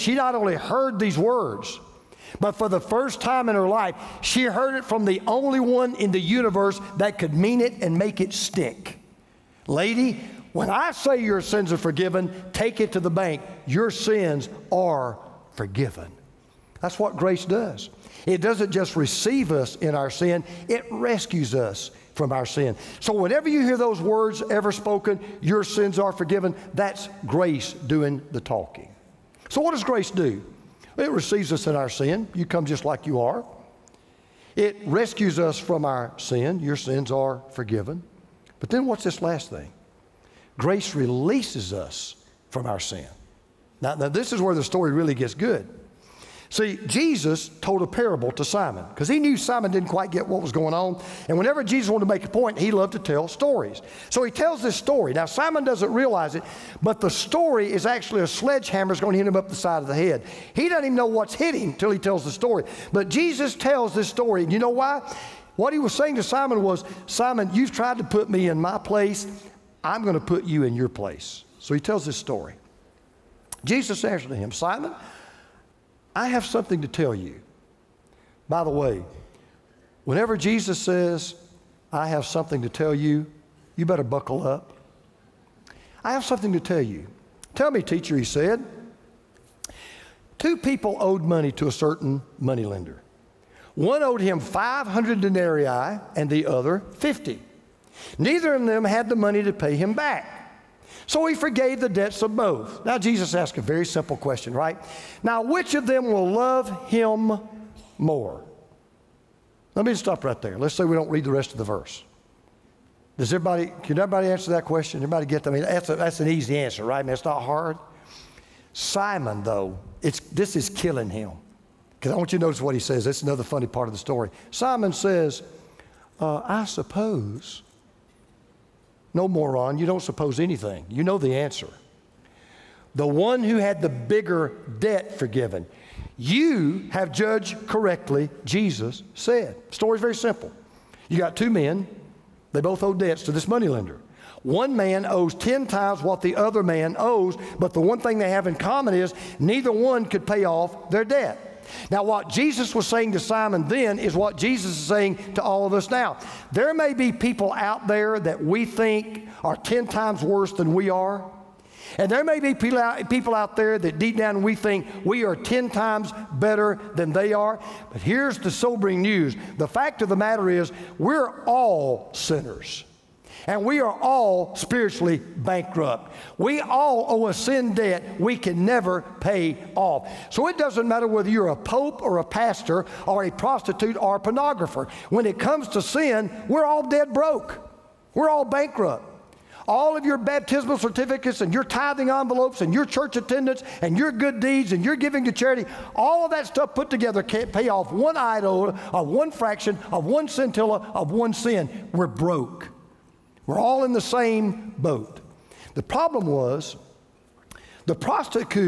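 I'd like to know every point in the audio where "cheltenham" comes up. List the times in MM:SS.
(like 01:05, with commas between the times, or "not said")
not said.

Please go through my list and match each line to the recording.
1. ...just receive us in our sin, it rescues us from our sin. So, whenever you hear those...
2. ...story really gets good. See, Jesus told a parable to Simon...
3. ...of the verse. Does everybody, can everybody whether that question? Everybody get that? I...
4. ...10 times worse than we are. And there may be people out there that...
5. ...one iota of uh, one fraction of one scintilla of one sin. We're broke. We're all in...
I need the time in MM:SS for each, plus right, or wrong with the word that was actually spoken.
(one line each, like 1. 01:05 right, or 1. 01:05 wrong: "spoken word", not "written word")
1. 00:18 right
2. 00:44 right
3. 01:51 wrong: "answer", not "whether"
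4. 02:39 right
5. 03:17 right.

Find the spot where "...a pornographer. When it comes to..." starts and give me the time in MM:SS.
03:04.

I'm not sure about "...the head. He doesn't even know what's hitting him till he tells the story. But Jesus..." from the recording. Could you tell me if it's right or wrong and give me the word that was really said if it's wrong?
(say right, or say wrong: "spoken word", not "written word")
right.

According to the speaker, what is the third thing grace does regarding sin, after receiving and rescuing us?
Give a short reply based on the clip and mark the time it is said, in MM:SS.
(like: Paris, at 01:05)
Releases us, at 00:40.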